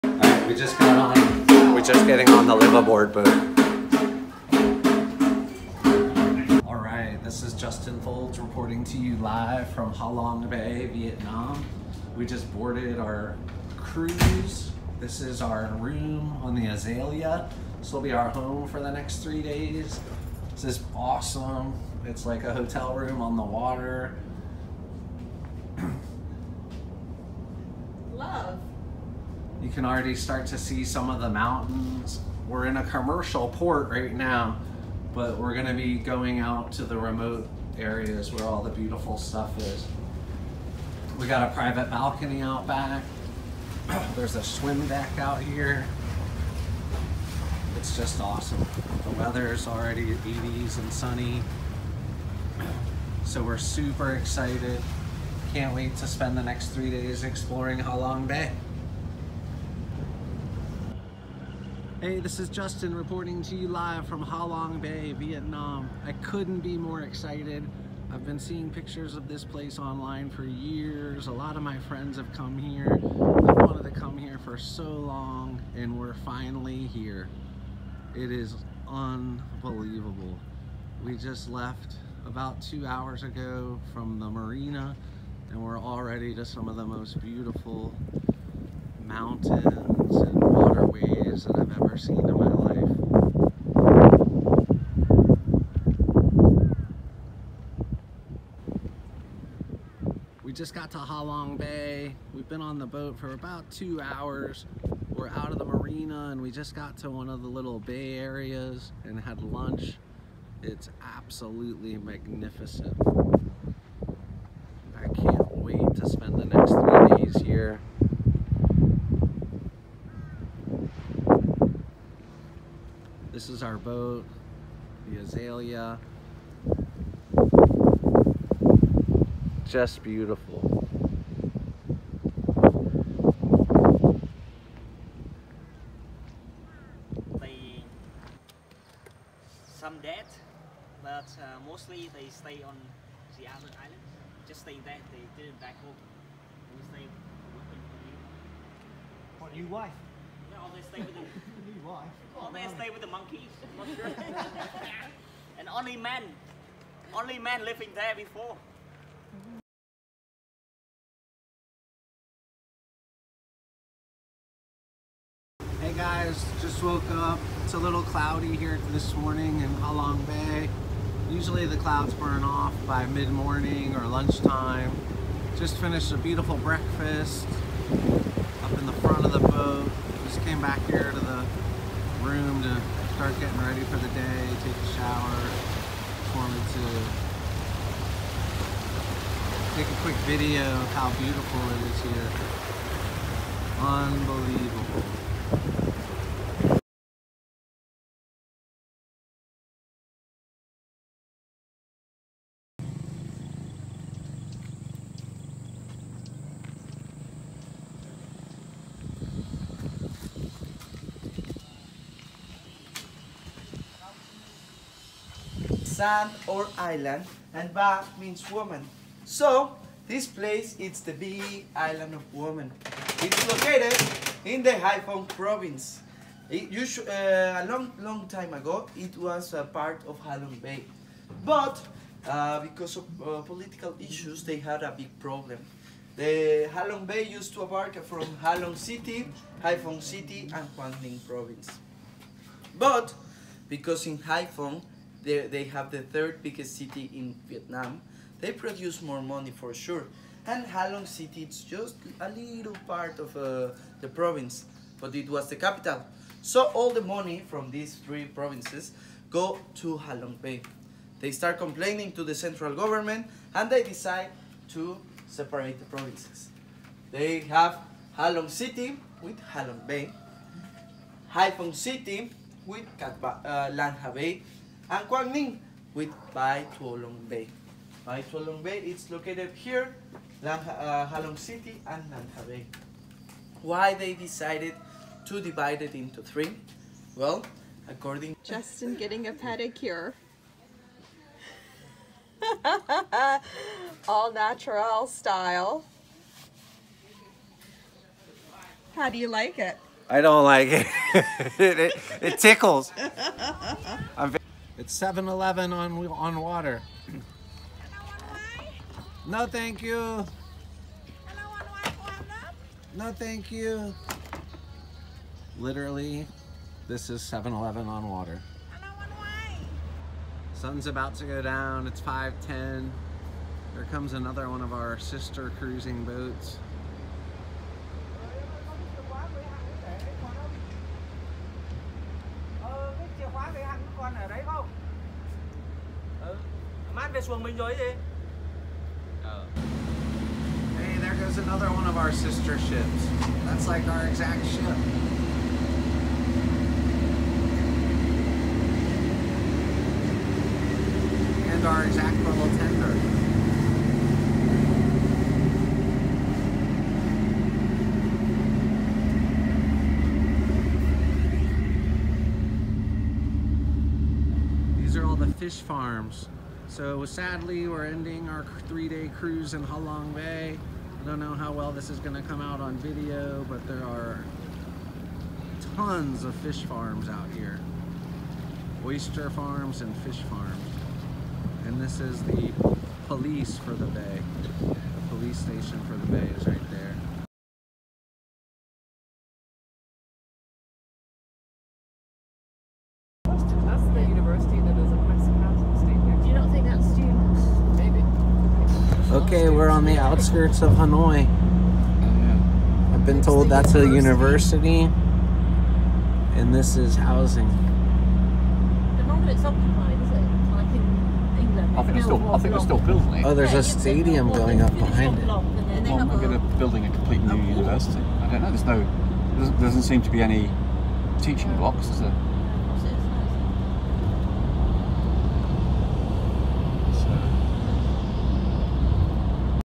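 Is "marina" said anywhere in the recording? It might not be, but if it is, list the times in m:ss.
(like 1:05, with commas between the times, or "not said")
1:24, 1:45.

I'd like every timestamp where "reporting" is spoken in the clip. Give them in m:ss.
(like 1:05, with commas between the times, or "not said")
0:08, 1:02.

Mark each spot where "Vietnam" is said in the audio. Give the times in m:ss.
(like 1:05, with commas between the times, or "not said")
0:10, 1:05, 4:07.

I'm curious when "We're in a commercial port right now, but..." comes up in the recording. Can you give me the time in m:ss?
0:32.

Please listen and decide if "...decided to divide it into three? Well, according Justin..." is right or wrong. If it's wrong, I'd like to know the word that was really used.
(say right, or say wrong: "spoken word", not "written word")
right.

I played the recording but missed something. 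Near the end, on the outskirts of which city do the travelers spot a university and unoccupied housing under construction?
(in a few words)
Hanoi.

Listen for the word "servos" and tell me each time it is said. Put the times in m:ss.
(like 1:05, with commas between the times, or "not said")
not said.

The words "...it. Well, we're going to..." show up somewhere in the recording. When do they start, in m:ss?
6:55.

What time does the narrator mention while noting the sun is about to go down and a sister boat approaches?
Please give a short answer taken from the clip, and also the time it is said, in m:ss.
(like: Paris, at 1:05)
5:10, at 5:22.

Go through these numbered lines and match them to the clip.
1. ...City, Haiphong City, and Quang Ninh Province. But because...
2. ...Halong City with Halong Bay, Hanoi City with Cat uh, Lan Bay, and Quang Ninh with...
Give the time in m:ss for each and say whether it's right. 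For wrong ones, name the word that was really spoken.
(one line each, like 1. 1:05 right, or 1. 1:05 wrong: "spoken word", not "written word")
1. 3:58 right
2. 4:28 wrong: "Haiphong", not "Hanoi".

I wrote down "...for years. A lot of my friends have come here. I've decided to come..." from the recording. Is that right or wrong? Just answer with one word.
wrong.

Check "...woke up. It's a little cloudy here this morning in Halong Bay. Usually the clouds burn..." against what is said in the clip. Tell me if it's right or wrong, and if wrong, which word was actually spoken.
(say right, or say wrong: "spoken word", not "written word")
right.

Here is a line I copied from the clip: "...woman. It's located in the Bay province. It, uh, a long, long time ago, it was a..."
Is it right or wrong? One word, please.
wrong.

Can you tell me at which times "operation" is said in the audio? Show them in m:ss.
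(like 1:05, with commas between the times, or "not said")
not said.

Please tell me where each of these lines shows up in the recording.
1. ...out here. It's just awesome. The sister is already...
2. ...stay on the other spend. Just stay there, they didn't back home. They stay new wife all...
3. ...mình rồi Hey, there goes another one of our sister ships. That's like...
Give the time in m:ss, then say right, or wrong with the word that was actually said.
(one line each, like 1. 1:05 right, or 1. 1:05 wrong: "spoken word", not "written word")
1. 0:45 wrong: "weather", not "sister"
2. 2:22 wrong: "island", not "spend"
3. 5:37 right.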